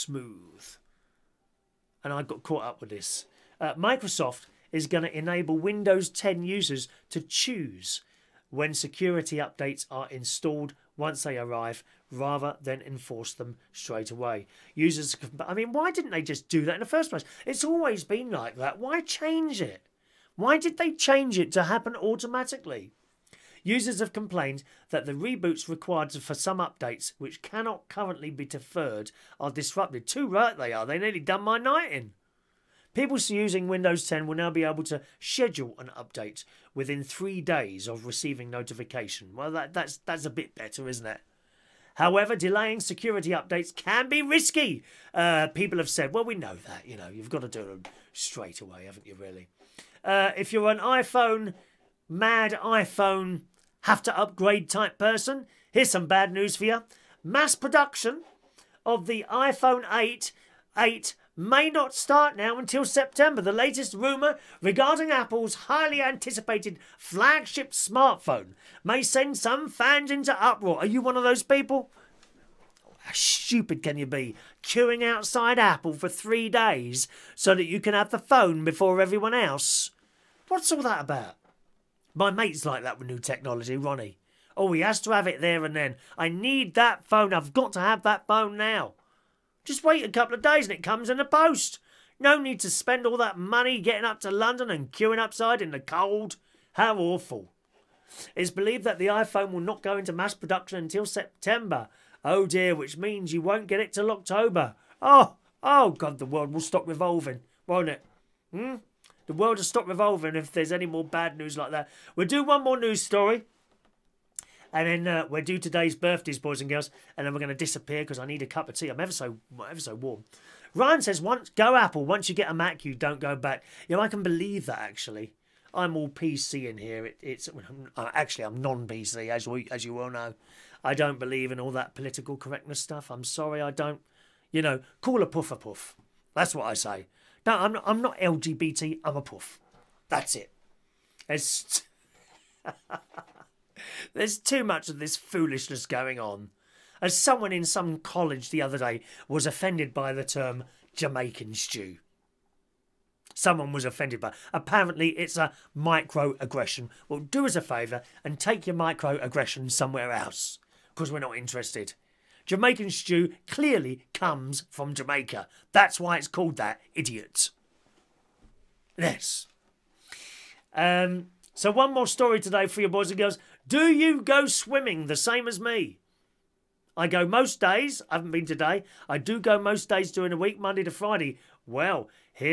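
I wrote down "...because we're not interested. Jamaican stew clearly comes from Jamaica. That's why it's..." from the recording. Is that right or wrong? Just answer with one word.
right.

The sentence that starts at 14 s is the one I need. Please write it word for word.
Users, I mean, why didn't they just do that in the first place?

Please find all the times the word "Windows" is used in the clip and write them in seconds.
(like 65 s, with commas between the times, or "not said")
5 s, 33 s.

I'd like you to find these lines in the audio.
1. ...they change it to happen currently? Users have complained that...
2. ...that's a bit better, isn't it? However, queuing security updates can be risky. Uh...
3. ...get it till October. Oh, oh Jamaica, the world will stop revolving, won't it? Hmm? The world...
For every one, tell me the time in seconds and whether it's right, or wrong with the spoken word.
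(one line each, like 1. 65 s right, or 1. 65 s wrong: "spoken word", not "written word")
1. 20 s wrong: "automatically", not "currently"
2. 39 s wrong: "delaying", not "queuing"
3. 103 s wrong: "God", not "Jamaica".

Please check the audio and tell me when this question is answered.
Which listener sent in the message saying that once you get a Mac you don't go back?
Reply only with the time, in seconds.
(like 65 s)
120 s.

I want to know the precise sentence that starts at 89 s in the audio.
Just wait a couple of days and it comes in the post.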